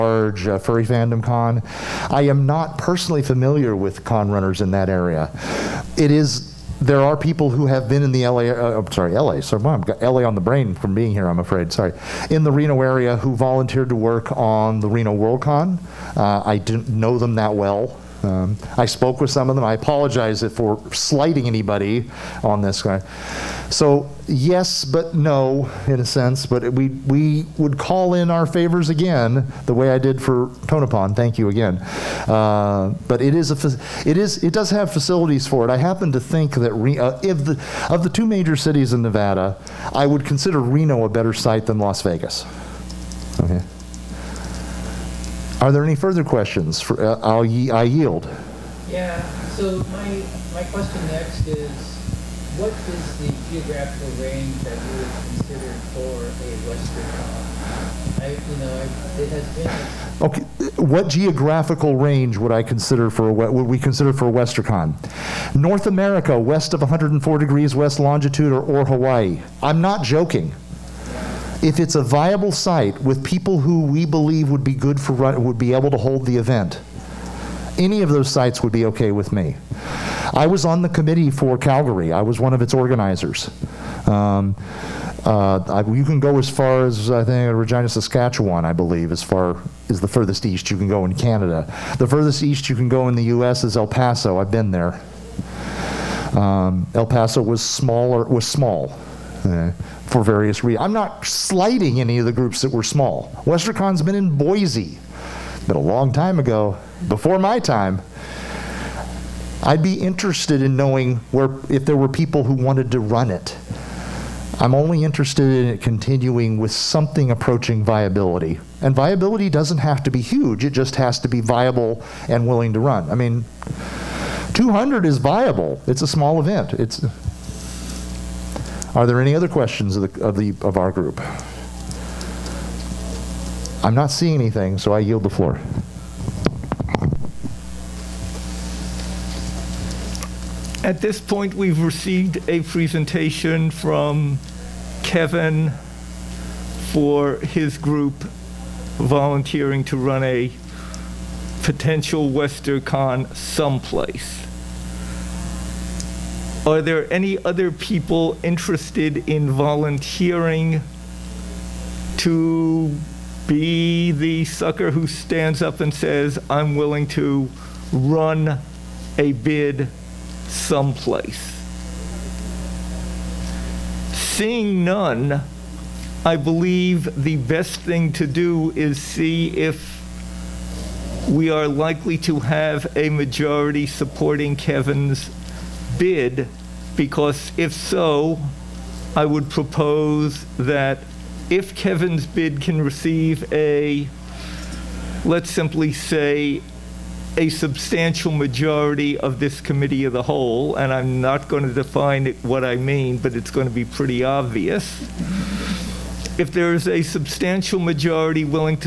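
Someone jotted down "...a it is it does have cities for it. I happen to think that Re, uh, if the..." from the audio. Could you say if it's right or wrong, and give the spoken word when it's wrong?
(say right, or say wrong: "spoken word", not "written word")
wrong: "facilities", not "cities".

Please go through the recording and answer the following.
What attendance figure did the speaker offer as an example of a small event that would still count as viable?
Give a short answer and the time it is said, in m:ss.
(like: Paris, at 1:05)
200, at 2:04.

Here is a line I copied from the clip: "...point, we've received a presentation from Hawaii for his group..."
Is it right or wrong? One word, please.
wrong.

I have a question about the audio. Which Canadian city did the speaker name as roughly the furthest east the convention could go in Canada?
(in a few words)
Regina, Saskatchewan.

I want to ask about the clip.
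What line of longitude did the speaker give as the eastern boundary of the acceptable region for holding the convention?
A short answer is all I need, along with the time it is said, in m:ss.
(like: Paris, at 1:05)
104 degrees west, at 1:06.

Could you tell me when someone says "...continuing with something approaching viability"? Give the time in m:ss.
1:55.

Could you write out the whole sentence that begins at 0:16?
Uh, I didn't know them that well um, I spoke with some of them.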